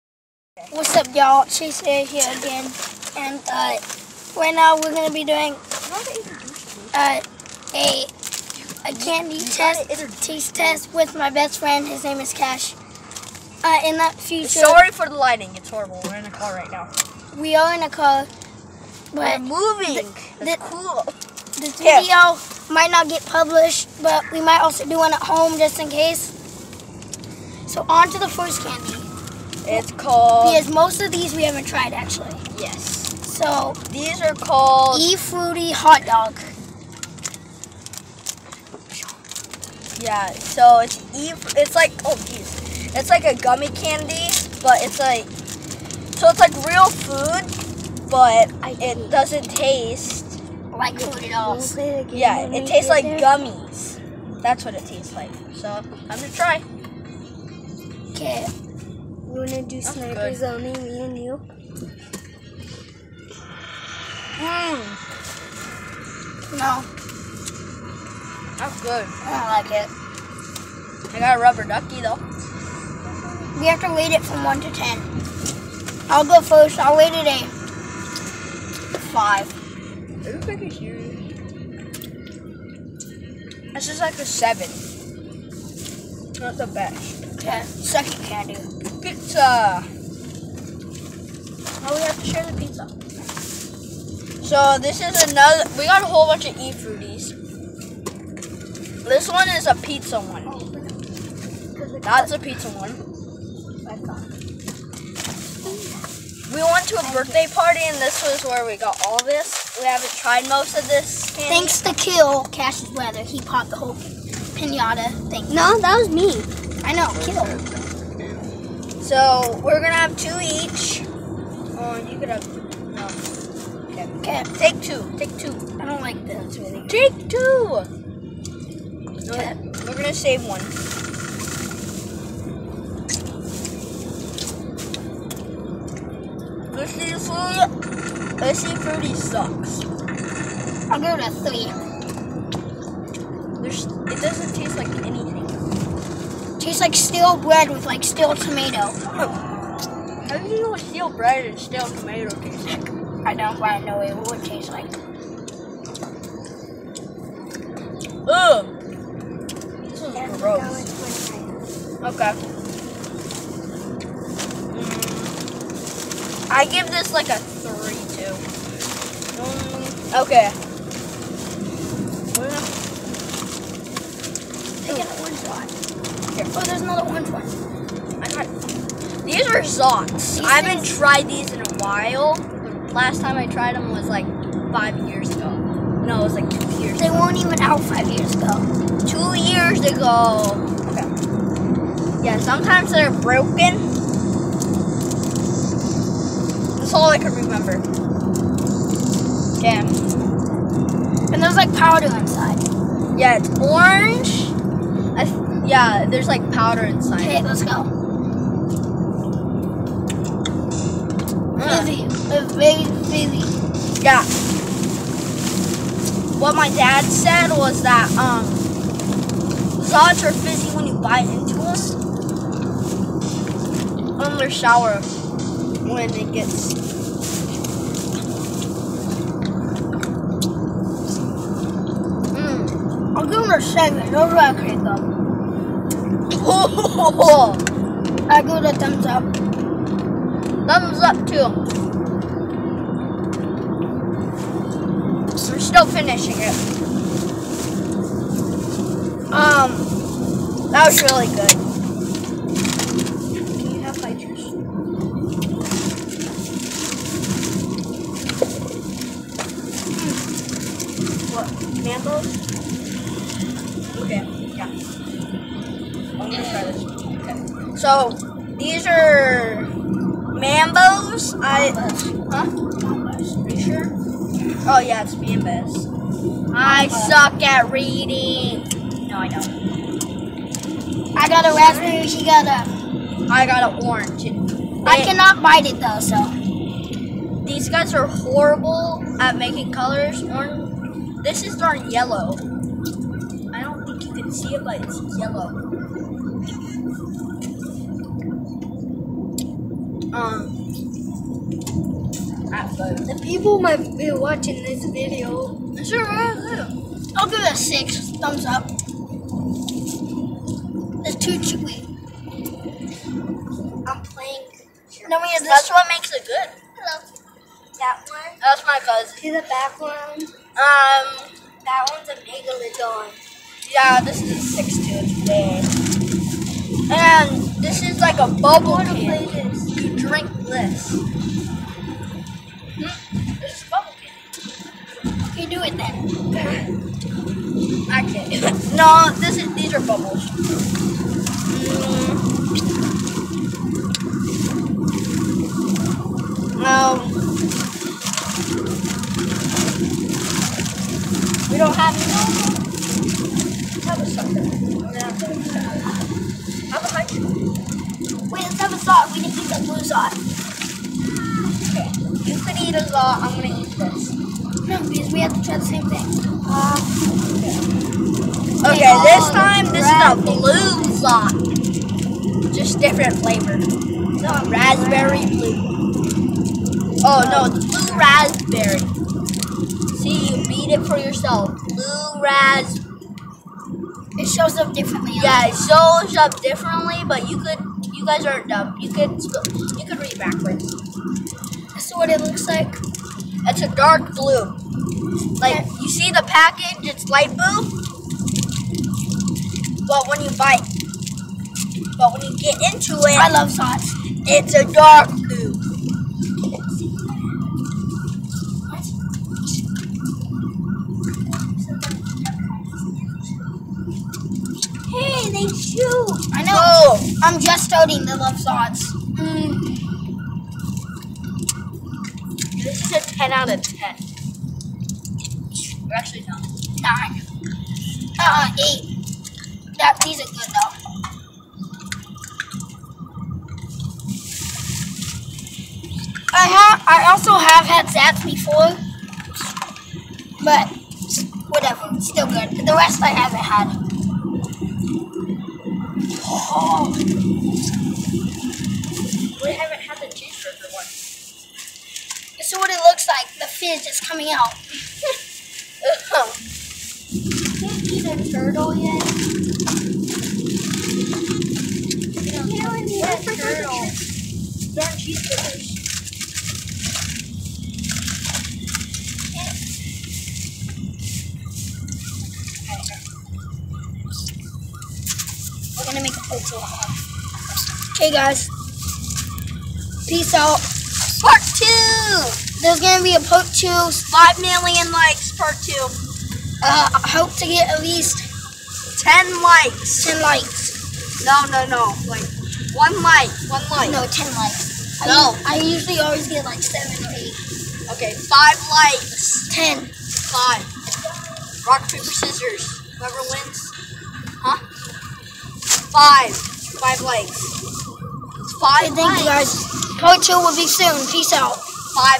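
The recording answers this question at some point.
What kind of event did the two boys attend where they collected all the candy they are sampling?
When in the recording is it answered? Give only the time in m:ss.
1:47.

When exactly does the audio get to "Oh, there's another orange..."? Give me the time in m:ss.
2:56.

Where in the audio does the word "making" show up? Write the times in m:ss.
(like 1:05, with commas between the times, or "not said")
4:49.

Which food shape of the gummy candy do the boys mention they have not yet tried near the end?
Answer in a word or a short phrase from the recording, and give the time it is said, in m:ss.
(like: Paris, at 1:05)
Cheeseburger, at 7:30.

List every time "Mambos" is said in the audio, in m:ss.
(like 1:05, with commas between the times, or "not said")
4:30, 4:35.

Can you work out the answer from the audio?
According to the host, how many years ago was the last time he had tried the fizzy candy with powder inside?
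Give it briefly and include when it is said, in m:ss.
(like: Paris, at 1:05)
2 years, at 3:09.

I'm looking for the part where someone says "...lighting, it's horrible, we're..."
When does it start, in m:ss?
0:15.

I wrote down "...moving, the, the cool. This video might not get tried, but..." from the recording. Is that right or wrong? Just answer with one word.
wrong.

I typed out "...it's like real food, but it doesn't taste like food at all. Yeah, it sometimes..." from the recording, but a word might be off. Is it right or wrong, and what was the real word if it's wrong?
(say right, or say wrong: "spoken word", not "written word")
wrong: "tastes", not "sometimes".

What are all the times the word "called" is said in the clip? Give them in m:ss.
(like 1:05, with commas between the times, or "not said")
0:29, 0:34.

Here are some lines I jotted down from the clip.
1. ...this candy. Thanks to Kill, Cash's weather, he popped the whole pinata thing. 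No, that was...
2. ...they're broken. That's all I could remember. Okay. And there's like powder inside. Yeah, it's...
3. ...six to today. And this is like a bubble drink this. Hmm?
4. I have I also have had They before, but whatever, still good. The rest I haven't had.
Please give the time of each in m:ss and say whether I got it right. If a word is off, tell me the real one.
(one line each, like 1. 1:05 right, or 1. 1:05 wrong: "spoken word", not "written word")
1. 1:50 right
2. 3:12 right
3. 5:24 right
4. 7:16 wrong: "Zats", not "They".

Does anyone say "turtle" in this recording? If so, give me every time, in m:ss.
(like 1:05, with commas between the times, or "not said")
7:38, 7:43.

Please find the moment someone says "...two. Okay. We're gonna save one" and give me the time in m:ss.
2:07.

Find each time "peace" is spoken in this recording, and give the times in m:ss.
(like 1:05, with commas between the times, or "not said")
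8:00, 8:31.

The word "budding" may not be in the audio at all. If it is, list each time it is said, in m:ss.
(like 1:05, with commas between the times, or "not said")
not said.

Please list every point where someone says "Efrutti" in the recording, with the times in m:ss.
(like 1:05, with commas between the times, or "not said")
0:34, 1:36.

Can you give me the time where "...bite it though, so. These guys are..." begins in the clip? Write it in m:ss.
4:45.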